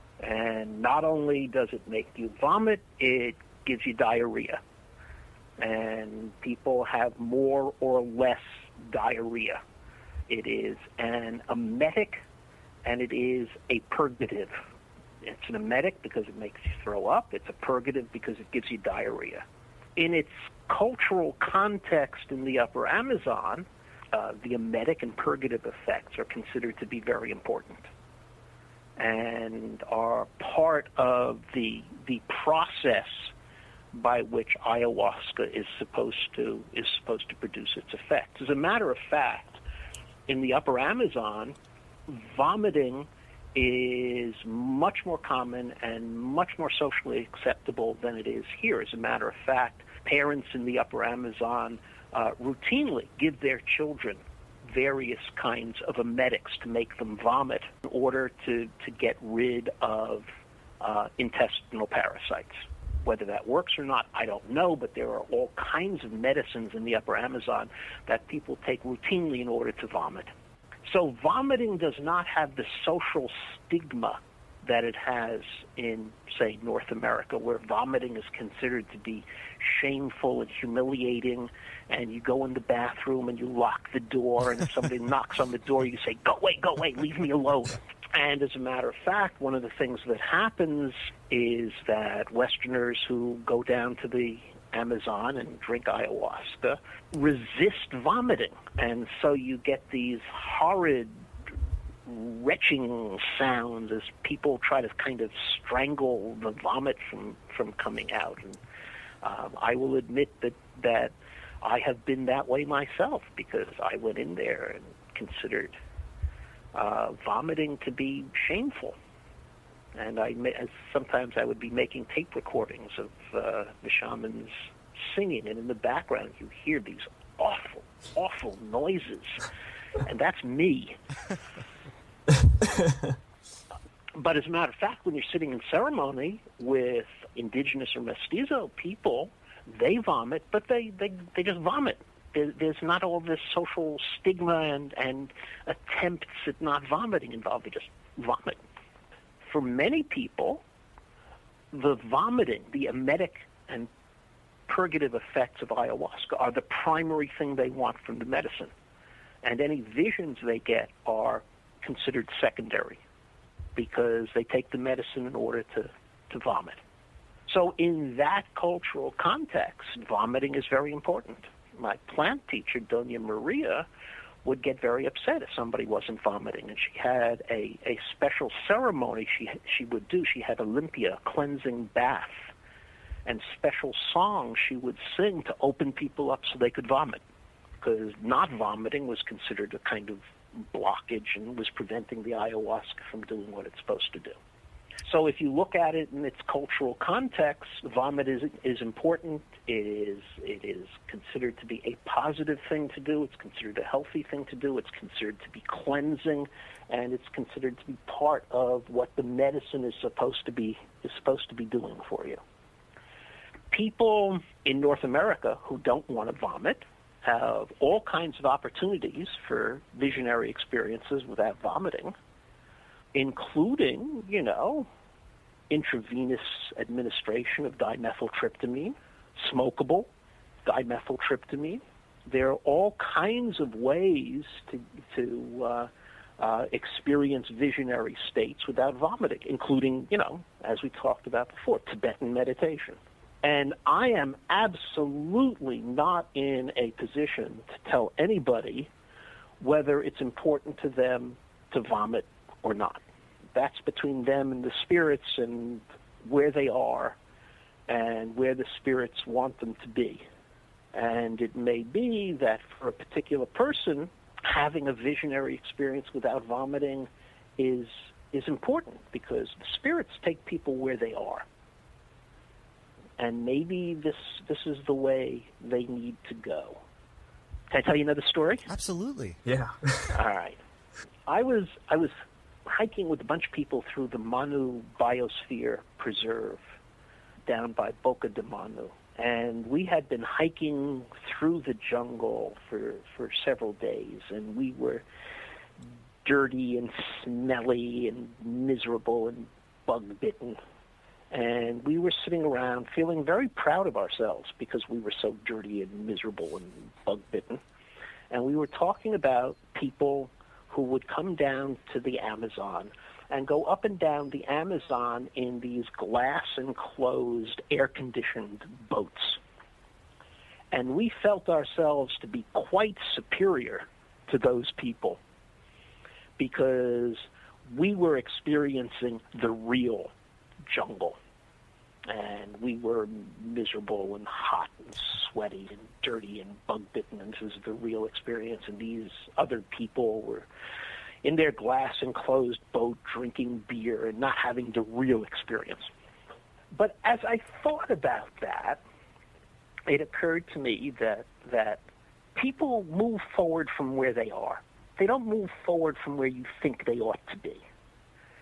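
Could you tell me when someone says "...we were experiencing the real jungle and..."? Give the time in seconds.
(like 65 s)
327 s.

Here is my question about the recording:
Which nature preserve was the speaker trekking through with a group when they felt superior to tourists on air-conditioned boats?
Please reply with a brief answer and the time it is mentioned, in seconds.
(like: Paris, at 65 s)
Manu Biosphere Preserve, at 284 s.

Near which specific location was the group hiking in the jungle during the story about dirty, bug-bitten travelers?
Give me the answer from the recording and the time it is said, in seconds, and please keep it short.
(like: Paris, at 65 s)
Boca de Manu, at 288 s.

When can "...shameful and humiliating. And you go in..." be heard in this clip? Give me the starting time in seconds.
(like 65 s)
79 s.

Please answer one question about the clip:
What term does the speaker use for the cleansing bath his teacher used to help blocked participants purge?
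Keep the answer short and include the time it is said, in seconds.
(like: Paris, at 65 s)
limpia, at 180 s.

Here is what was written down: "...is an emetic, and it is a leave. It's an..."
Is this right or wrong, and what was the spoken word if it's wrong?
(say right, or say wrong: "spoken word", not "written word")
wrong: "purgative", not "leave".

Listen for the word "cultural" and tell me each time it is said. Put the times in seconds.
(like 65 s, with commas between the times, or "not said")
20 s, 168 s, 196 s.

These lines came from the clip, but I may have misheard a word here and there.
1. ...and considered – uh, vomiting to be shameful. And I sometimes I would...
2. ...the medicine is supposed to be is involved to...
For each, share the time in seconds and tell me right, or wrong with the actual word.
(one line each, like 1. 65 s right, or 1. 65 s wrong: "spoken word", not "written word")
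1. 114 s right
2. 209 s wrong: "supposed", not "involved".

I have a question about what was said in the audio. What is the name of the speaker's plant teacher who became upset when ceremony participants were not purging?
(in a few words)
Dona Maria.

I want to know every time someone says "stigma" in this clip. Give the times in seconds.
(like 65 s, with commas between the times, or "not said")
73 s, 144 s.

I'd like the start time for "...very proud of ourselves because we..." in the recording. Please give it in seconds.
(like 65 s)
303 s.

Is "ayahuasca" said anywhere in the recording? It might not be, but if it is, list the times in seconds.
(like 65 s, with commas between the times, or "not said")
34 s, 95 s, 155 s, 192 s.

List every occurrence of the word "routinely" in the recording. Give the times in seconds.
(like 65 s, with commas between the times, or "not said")
52 s, 68 s.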